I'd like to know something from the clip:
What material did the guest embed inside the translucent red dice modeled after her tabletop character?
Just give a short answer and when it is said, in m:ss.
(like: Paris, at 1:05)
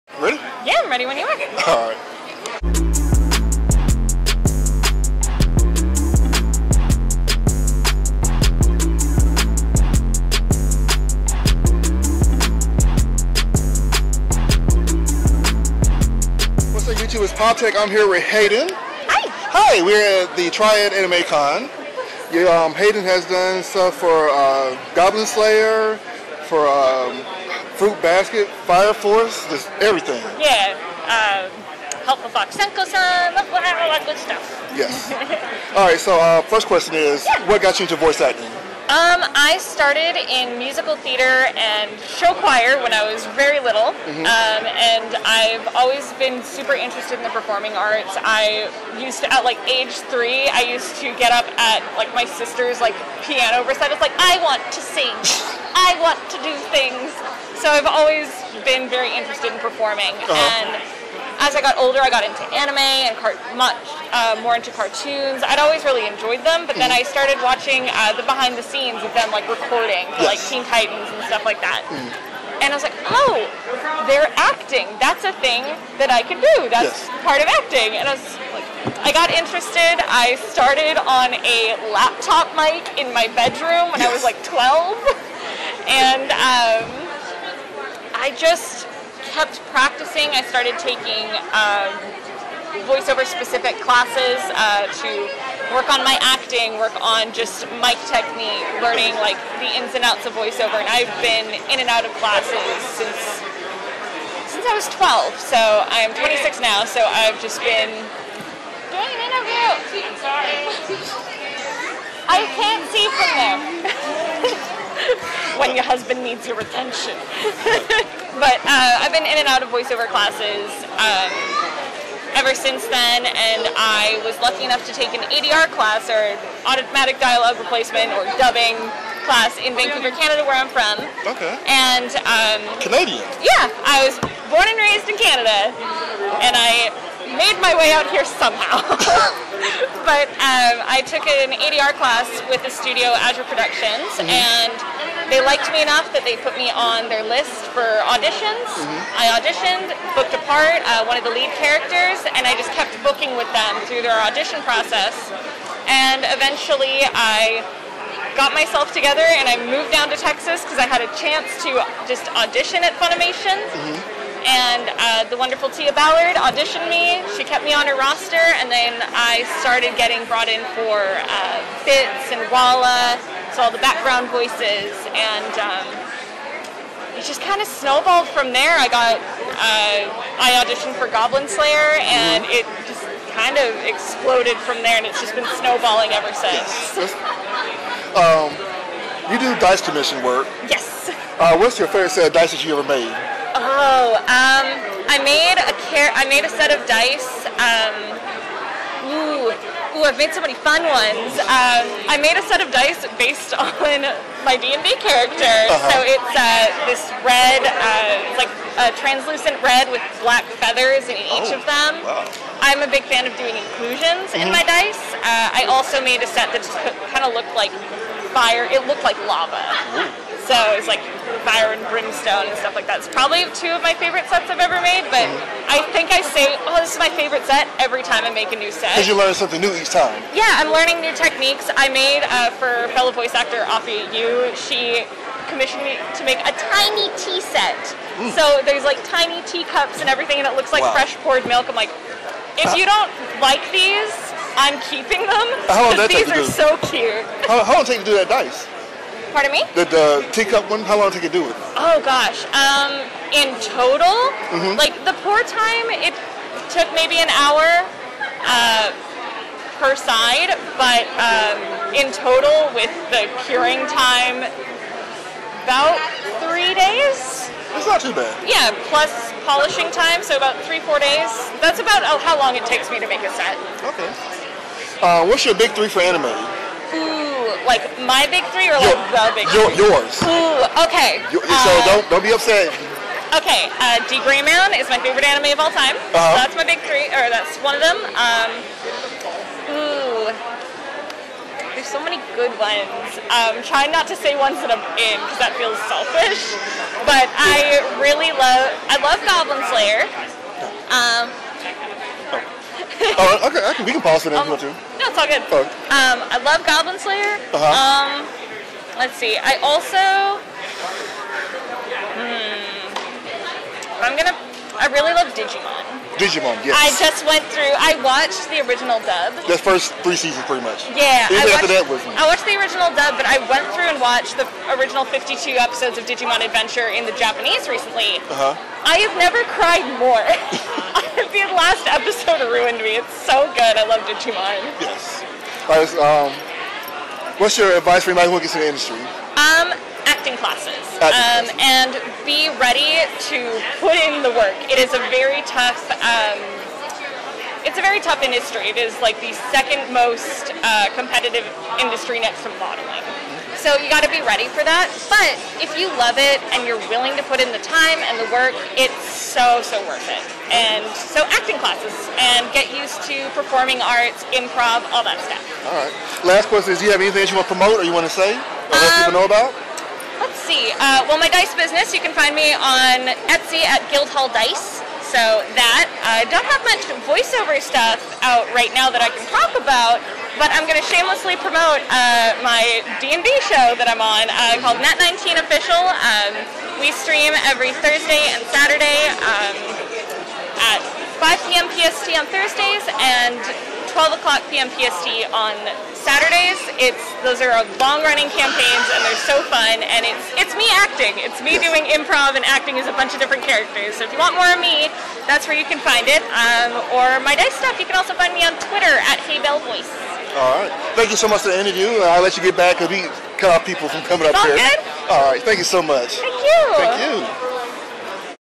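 black feathers, at 3:30.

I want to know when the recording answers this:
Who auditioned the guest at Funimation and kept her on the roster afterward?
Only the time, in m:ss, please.
2:45.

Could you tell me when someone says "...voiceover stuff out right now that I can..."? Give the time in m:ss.
6:17.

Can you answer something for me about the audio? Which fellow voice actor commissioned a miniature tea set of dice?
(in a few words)
Apphia Yu.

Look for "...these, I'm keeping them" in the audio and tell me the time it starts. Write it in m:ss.
4:03.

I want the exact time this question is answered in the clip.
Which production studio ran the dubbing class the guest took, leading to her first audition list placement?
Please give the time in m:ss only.
2:23.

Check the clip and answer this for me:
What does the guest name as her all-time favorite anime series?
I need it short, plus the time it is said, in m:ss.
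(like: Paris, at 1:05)
D Gray Man, at 4:44.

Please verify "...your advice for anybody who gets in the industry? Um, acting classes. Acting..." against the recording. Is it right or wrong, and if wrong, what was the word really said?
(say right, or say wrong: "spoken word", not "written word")
right.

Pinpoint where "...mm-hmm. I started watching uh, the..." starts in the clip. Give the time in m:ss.
1:06.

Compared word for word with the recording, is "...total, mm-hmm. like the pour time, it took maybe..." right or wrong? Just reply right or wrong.
right.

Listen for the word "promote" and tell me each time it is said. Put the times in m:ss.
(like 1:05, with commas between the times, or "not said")
6:07, 6:21.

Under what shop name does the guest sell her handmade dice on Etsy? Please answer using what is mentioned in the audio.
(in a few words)
Guildhall Dice.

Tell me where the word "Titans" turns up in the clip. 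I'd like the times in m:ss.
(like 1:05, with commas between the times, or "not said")
1:10.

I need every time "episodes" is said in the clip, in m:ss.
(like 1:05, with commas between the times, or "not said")
5:25, 5:31.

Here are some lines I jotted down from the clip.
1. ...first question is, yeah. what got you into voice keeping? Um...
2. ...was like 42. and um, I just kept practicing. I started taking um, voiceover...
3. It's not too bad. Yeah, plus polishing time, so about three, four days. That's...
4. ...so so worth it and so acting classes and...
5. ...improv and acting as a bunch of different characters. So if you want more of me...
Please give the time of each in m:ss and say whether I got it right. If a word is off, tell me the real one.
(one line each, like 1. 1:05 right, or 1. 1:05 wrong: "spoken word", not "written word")
1. 0:36 wrong: "acting", not "keeping"
2. 1:24 wrong: "12", not "42"
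3. 4:27 right
4. 5:59 right
5. 6:41 right.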